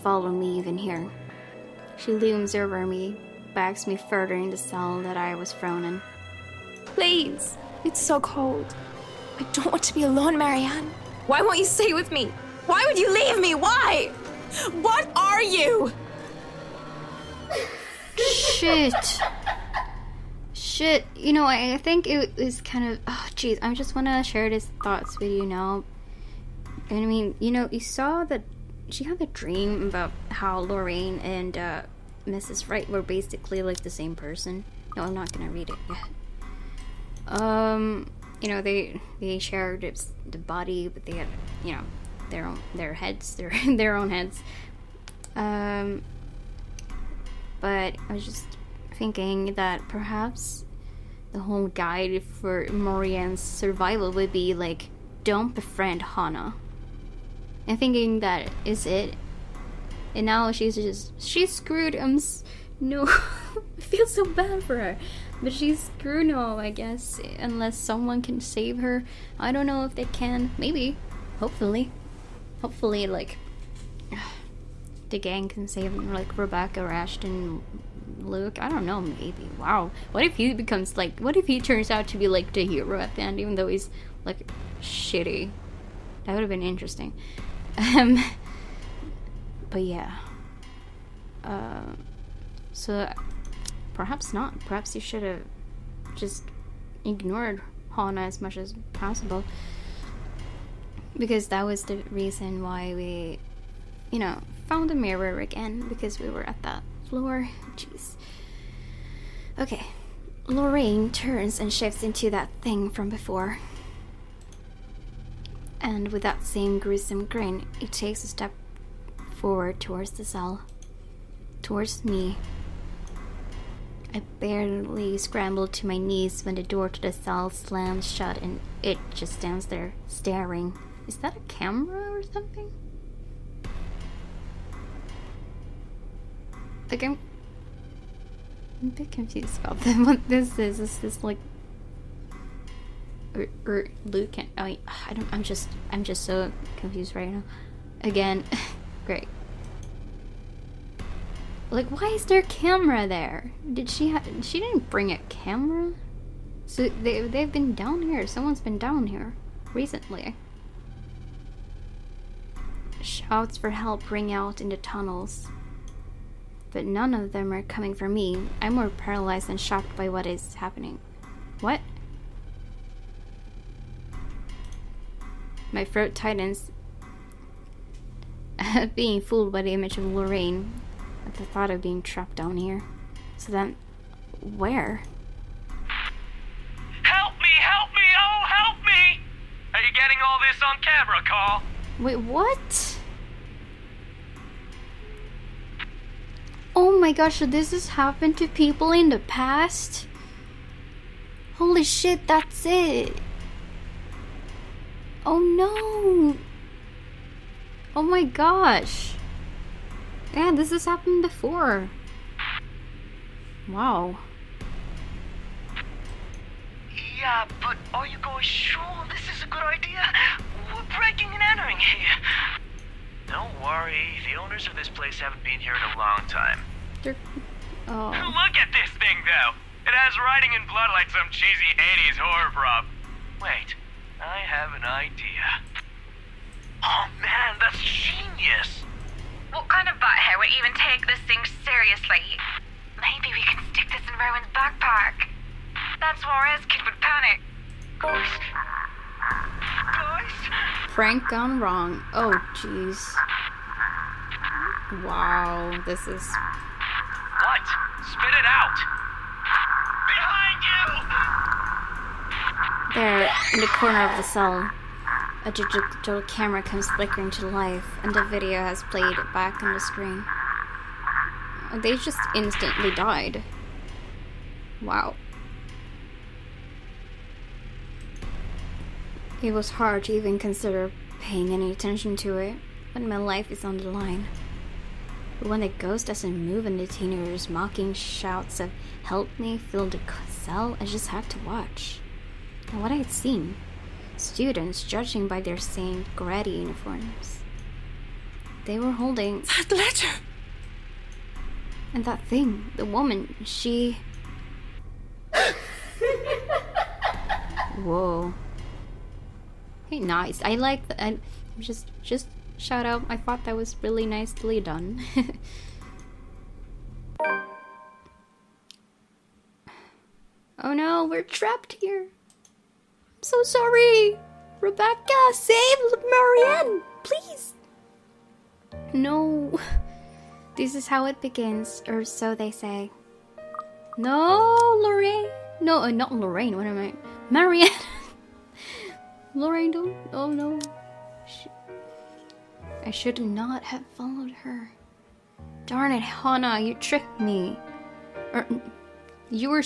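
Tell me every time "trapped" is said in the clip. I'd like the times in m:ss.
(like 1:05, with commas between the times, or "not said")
3:02, 5:21.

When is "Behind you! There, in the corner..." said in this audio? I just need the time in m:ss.
4:20.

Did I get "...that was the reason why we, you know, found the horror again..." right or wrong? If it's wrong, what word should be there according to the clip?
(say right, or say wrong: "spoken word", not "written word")
wrong: "mirror", not "horror".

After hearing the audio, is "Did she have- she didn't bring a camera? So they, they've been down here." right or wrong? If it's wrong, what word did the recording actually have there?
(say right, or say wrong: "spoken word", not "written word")
right.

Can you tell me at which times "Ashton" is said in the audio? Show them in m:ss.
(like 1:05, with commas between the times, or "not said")
1:16.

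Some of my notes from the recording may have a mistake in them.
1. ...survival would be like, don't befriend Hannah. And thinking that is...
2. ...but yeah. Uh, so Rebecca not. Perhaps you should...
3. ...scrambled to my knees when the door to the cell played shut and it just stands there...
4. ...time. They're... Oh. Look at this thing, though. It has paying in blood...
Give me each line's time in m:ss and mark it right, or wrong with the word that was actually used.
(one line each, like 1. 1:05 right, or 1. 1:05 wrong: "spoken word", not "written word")
1. 0:53 right
2. 1:29 wrong: "Perhaps", not "Rebecca"
3. 2:05 wrong: "slammed", not "played"
4. 3:46 wrong: "writing", not "paying".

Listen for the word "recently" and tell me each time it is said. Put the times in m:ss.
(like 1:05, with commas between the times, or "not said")
2:39.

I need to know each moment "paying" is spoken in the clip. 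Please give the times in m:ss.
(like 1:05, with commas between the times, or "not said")
4:41.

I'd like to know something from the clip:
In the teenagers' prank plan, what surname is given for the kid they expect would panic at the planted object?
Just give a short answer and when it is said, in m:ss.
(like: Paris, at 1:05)
Suarez, at 4:06.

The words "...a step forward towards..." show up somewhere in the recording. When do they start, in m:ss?
1:58.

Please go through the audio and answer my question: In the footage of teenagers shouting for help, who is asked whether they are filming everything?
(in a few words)
Carl.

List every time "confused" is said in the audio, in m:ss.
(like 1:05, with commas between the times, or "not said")
2:19, 2:26.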